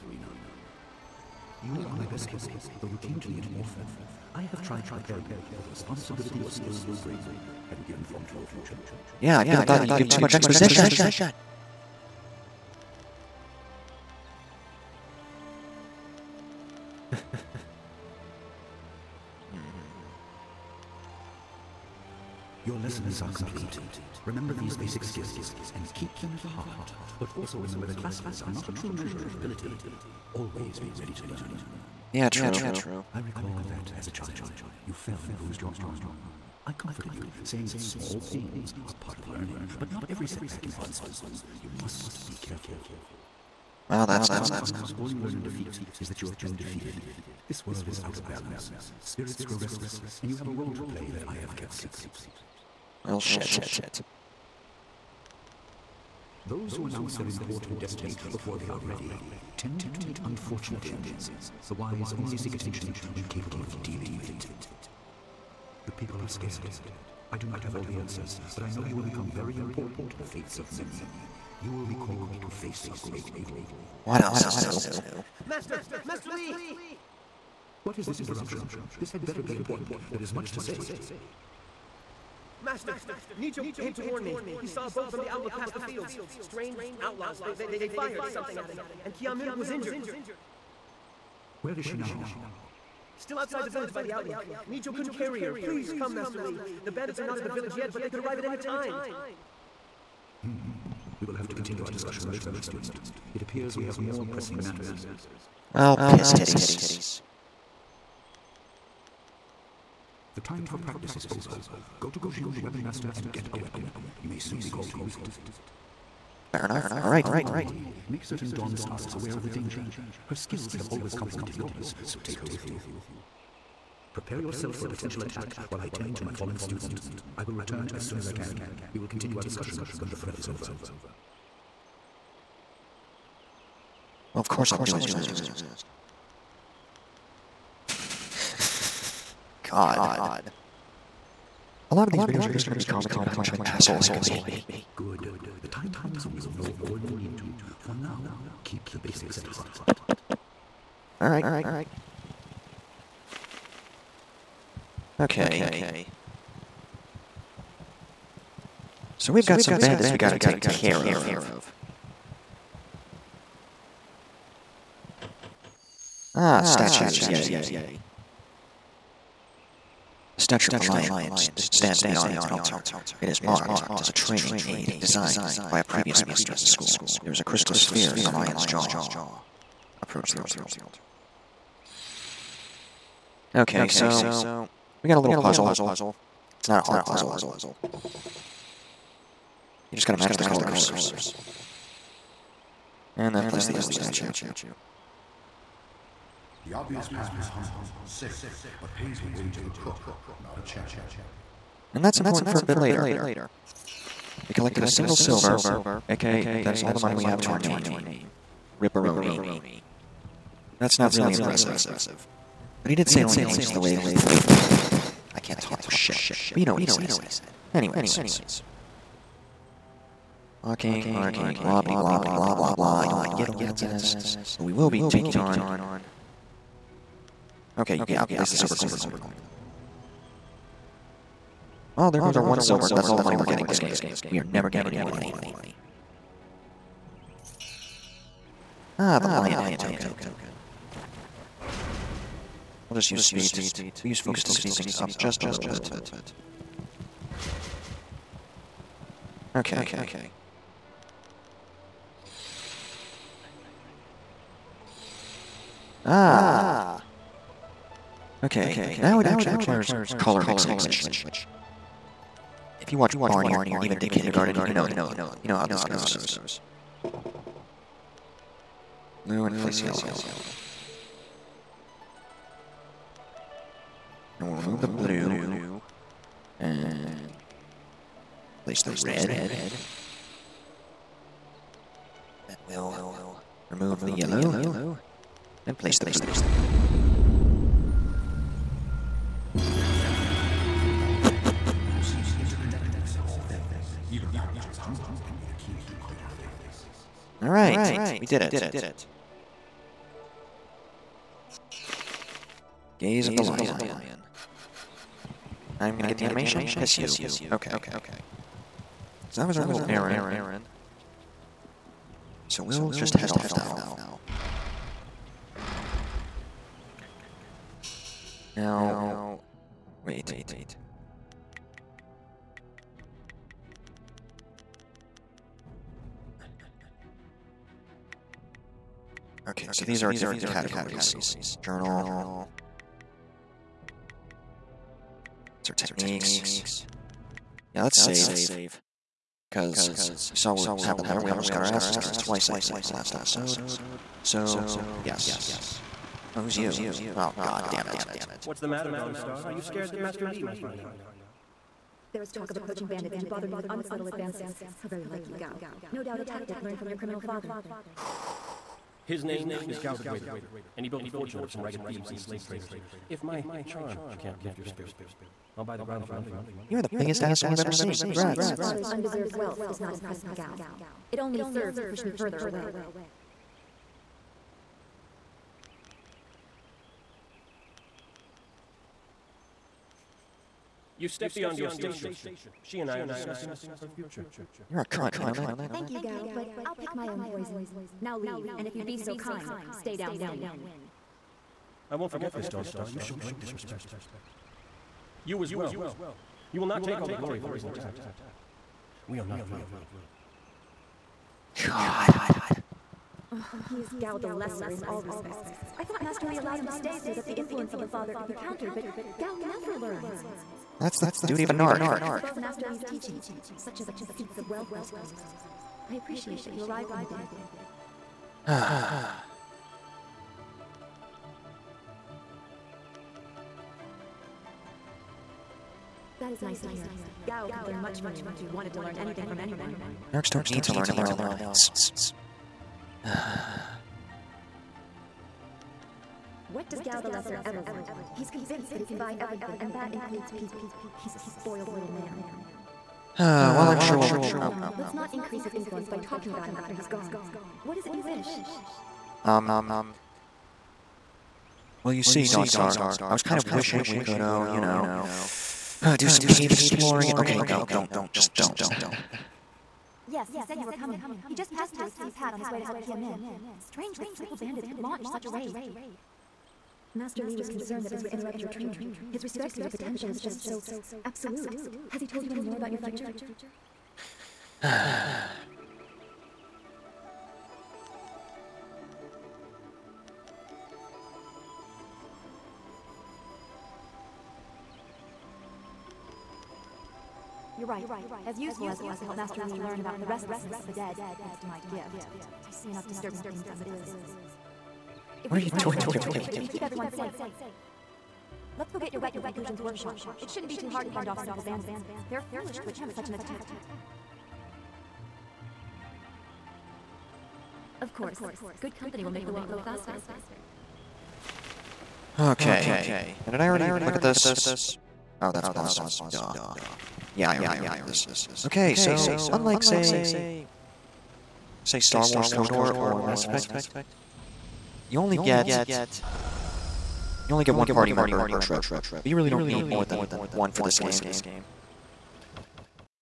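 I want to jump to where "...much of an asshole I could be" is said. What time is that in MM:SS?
02:23.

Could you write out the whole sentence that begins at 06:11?
It only serves to push me further away.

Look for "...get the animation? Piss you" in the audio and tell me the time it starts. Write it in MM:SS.
05:06.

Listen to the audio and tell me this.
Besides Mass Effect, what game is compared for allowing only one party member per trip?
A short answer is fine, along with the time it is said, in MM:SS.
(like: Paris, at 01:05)
Star Wars KOTOR, at 08:41.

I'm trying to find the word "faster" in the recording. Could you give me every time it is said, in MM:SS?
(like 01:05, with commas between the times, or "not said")
08:29.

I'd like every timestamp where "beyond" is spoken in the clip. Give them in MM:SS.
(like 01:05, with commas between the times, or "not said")
02:52, 06:21.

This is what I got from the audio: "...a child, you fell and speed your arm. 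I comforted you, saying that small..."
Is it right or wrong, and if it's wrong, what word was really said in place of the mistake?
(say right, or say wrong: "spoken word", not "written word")
wrong: "bruised", not "speed".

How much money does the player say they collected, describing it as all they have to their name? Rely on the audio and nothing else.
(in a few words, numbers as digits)
A single silver.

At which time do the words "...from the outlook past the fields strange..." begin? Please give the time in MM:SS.
01:25.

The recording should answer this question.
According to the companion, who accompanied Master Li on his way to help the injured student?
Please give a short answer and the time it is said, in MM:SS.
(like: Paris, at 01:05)
Si Pat, at 07:41.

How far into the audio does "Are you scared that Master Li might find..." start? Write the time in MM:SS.
05:49.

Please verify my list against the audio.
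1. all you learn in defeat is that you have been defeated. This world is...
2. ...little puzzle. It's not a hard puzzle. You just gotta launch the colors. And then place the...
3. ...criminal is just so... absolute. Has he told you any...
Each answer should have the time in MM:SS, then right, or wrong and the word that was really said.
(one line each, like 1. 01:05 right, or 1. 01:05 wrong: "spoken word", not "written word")
1. 00:45 right
2. 03:05 wrong: "match", not "launch"
3. 07:49 wrong: "potential", not "criminal".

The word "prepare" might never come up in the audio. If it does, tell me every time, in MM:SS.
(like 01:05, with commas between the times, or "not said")
00:04, 02:04.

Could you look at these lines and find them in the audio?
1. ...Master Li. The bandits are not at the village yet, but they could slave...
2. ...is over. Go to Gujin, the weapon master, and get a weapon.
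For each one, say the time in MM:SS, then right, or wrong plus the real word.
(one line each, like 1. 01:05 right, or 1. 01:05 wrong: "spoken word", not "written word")
1. 01:36 wrong: "arrive", not "slave"
2. 01:51 right.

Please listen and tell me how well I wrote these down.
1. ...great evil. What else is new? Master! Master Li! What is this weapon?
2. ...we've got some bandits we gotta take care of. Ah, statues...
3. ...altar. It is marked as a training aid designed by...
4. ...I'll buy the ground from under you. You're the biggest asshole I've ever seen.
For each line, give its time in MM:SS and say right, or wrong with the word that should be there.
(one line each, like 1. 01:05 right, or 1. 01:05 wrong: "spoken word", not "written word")
1. 01:13 wrong: "interruption", not "weapon"
2. 02:39 right
3. 02:52 right
4. 06:05 right.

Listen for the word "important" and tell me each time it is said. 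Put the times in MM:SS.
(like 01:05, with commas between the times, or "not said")
00:57, 01:09, 01:19, 03:22.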